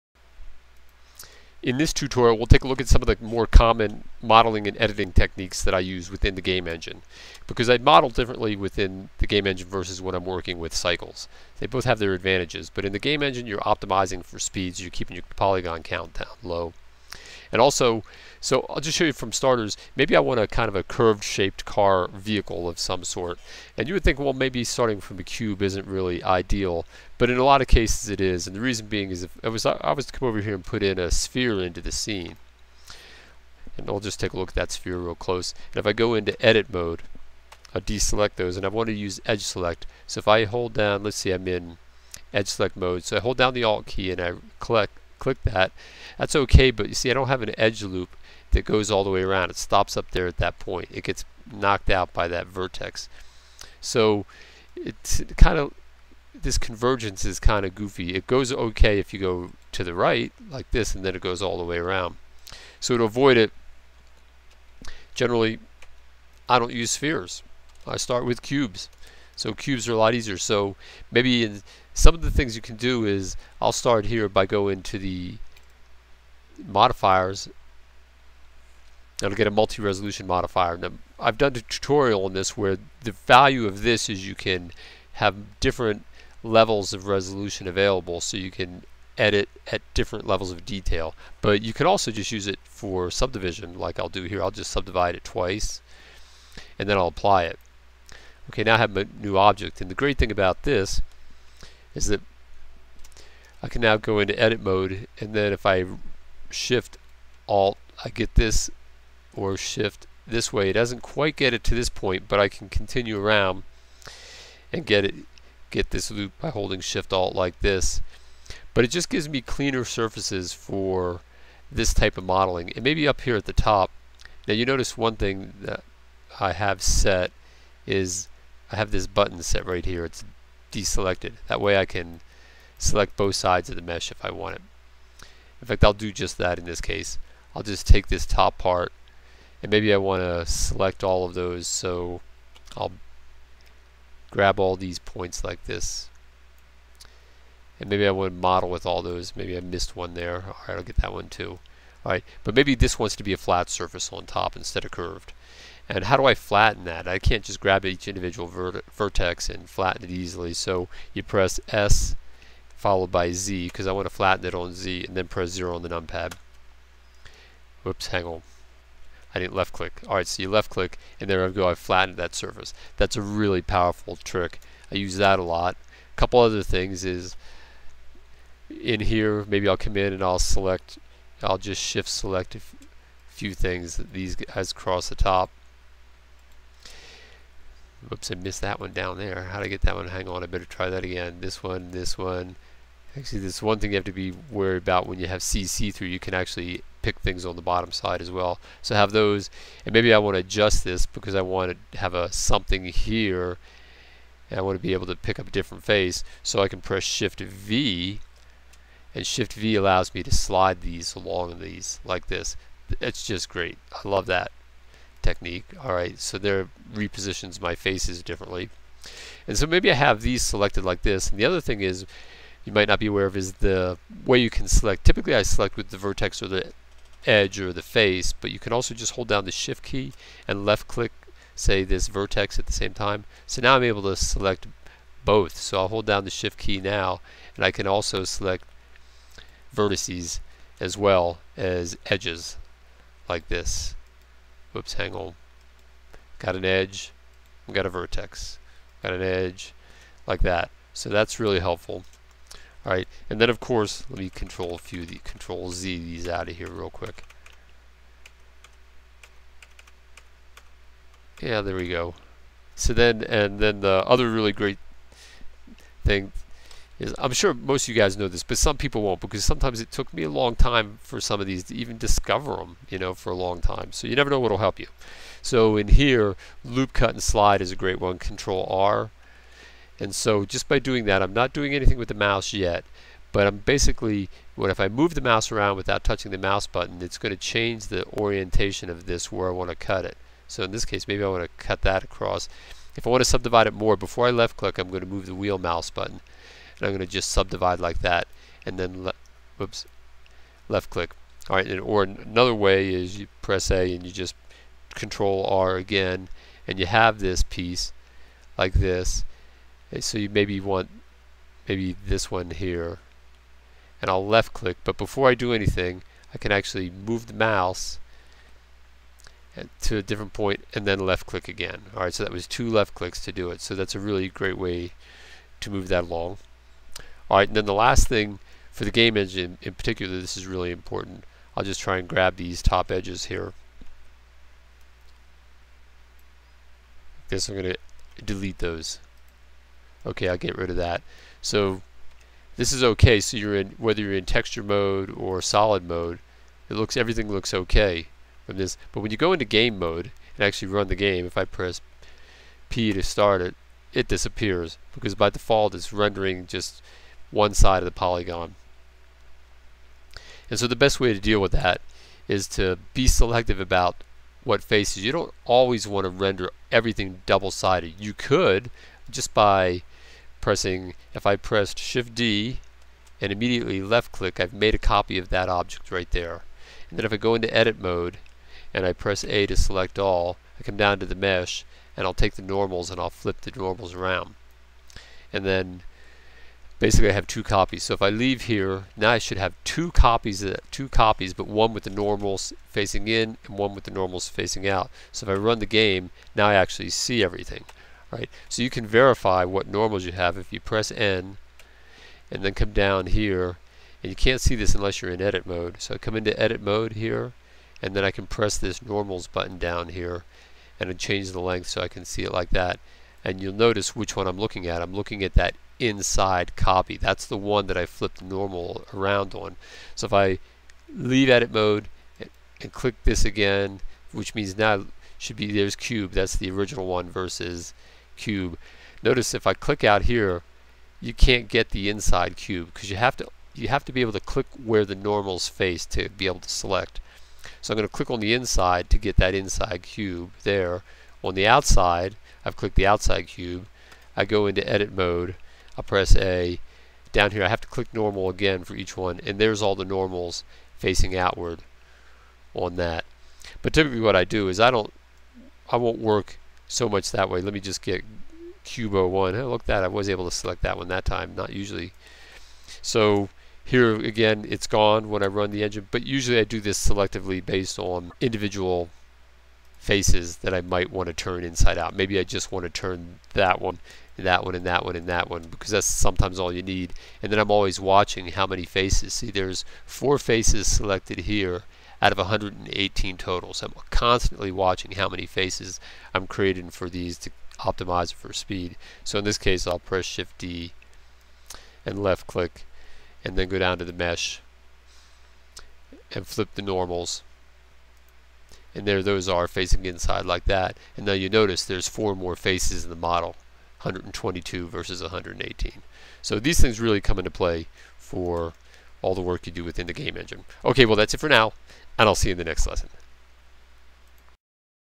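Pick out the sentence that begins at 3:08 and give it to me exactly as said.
Oops, I missed that one down there.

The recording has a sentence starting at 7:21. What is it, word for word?
On the outside, I've clicked the outside cube.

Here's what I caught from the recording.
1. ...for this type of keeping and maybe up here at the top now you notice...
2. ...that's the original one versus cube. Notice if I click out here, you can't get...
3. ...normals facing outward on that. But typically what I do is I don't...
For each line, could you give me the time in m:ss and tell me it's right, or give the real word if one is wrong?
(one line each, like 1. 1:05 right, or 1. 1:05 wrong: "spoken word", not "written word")
1. 2:00 wrong: "modeling", not "keeping"
2. 7:06 right
3. 7:29 right.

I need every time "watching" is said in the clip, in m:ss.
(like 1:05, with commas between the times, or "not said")
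7:57, 8:04.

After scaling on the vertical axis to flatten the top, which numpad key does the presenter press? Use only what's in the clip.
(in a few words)
0.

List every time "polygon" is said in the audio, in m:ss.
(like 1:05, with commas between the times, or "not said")
0:15, 5:57.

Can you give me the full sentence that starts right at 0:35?
And if I go into edit mode, I deselect those and I want to use edge select.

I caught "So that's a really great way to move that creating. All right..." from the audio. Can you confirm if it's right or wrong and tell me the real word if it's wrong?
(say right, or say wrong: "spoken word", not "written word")
wrong: "along", not "creating".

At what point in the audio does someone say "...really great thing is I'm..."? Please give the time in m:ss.
4:24.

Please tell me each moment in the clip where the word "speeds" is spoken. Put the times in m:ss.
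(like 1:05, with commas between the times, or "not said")
0:14, 8:08.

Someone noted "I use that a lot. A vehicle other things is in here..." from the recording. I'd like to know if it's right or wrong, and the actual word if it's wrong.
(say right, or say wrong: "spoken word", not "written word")
wrong: "couple", not "vehicle".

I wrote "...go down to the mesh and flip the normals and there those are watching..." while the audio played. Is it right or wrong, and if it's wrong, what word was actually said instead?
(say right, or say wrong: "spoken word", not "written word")
wrong: "facing", not "watching".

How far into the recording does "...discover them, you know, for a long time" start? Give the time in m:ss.
4:31.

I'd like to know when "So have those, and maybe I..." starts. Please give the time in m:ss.
3:18.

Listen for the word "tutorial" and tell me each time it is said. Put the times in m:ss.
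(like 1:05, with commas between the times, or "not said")
0:01, 1:21.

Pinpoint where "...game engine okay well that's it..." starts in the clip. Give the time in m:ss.
8:29.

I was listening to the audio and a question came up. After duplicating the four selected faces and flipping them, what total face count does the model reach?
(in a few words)
122.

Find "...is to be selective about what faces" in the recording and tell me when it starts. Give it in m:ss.
6:02.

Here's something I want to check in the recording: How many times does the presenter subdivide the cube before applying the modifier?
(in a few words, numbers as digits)
Twice.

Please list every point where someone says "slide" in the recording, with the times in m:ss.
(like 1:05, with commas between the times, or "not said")
3:30, 4:37.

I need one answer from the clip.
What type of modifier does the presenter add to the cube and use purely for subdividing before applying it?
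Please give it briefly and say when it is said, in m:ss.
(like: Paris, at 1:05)
Multi-resolution, at 1:19.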